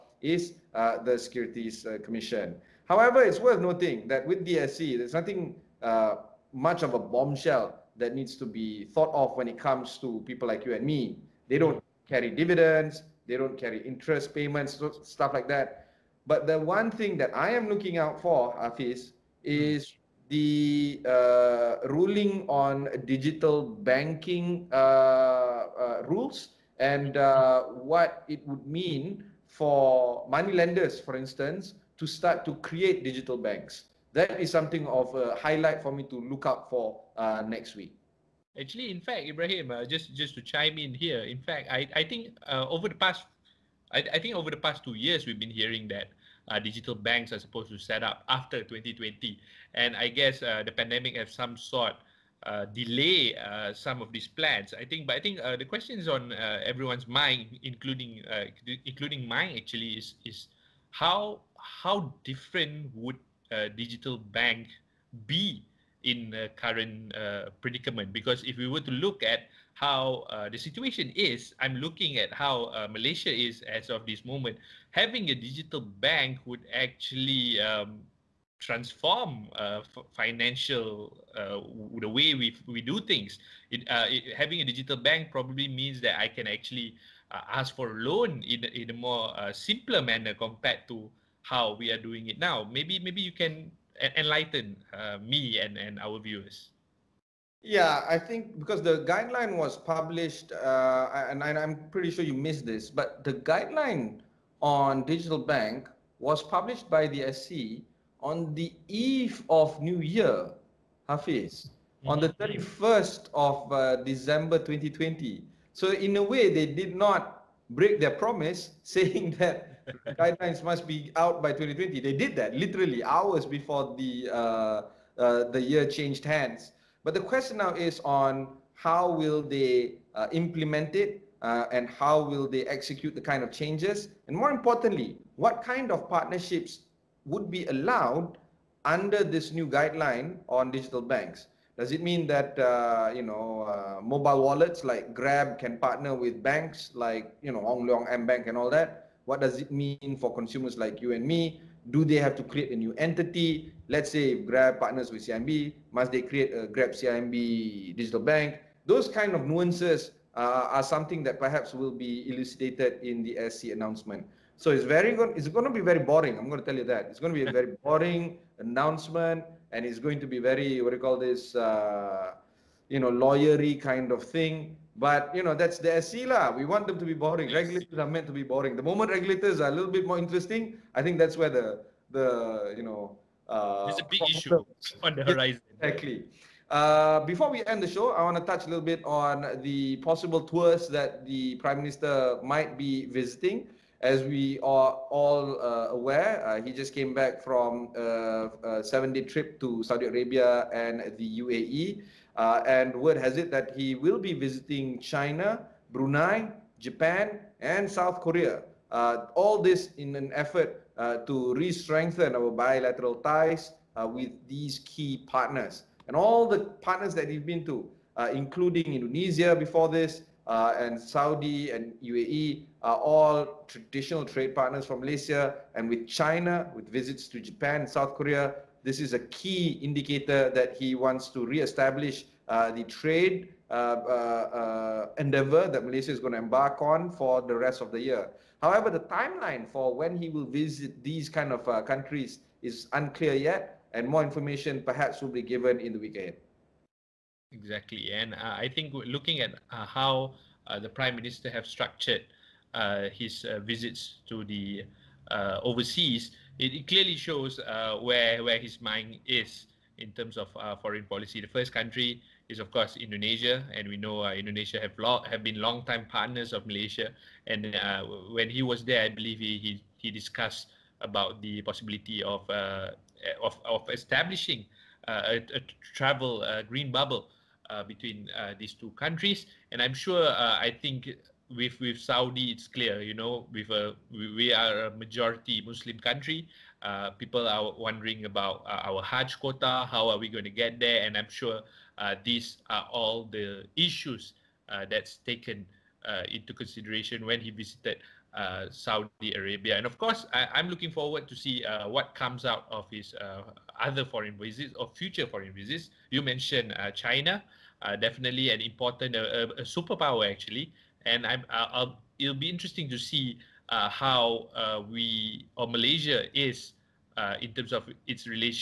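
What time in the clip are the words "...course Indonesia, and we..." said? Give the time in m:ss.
4:22.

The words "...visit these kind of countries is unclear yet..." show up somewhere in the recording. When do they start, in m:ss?
4:00.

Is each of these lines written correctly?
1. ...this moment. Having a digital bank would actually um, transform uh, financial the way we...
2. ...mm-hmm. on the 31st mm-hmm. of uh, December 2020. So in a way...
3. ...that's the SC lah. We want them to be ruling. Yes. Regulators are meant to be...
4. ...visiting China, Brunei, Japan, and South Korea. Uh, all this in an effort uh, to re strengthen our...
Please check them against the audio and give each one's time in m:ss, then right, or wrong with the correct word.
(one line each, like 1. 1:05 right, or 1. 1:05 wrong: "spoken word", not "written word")
1. 1:14 right
2. 1:52 right
3. 2:55 wrong: "boring", not "ruling"
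4. 3:24 right.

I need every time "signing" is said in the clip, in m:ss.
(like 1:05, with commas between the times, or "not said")
not said.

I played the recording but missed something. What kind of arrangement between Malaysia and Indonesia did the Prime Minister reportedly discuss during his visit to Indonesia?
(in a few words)
travel green bubble.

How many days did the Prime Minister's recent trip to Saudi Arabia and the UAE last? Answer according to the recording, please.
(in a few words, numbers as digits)
7.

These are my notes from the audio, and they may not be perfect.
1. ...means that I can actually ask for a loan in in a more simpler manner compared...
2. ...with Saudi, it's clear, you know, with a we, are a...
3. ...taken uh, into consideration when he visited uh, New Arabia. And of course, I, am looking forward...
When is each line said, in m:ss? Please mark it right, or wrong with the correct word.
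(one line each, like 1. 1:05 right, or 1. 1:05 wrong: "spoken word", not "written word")
1. 1:25 right
2. 4:41 right
3. 4:55 wrong: "Saudi", not "New".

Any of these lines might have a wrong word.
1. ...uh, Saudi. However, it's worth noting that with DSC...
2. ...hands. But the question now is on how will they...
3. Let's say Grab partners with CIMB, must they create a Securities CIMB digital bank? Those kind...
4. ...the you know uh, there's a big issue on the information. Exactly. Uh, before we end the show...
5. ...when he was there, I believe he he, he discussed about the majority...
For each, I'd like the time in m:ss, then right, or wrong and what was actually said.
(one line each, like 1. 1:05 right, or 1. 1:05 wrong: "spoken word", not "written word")
1. 0:01 wrong: "Commission", not "Saudi"
2. 2:06 right
3. 2:33 wrong: "Grab", not "Securities"
4. 3:02 wrong: "horizon", not "information"
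5. 4:28 wrong: "possibility", not "majority".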